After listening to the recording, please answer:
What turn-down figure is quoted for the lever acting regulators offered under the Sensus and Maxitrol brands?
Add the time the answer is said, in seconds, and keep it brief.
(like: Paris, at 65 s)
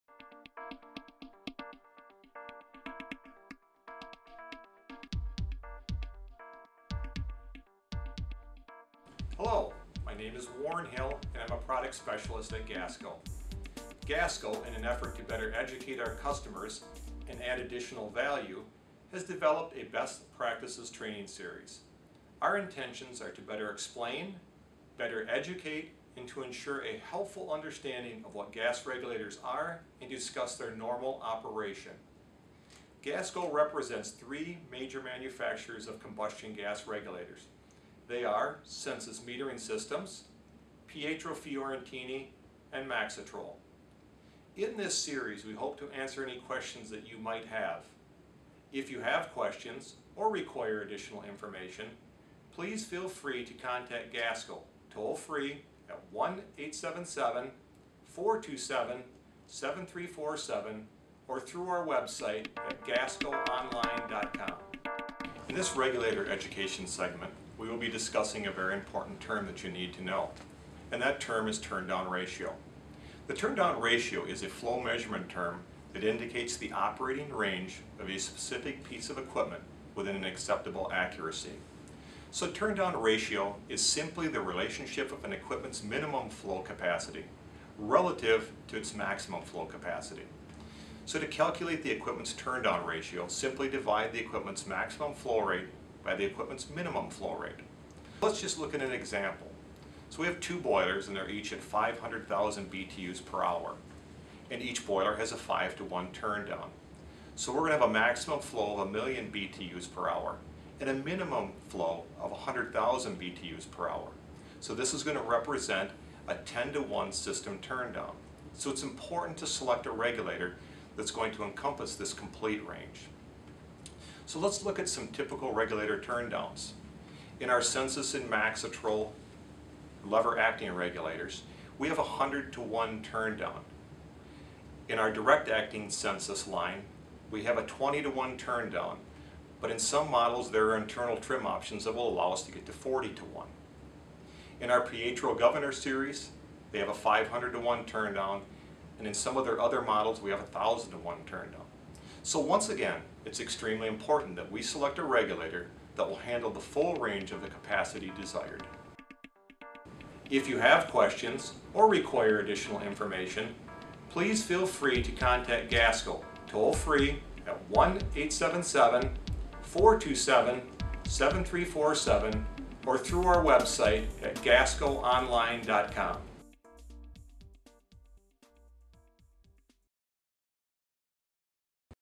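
100 to 1, at 132 s.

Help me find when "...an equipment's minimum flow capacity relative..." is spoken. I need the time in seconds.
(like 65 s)
85 s.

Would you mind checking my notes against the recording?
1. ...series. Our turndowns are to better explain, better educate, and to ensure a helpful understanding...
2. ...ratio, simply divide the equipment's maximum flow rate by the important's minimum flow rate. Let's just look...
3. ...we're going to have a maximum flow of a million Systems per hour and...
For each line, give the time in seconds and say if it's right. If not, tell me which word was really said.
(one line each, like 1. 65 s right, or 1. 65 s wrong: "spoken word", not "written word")
1. 21 s wrong: "intentions", not "turndowns"
2. 92 s wrong: "equipment", not "important"
3. 107 s wrong: "BTUs", not "Systems".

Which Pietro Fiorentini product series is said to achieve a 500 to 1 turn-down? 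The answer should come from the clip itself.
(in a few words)
Governor series.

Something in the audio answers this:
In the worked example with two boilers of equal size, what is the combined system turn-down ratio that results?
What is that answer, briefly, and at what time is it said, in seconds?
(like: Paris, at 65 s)
10 to 1, at 116 s.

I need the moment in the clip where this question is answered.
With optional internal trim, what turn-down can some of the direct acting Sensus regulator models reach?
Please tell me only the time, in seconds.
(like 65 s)
142 s.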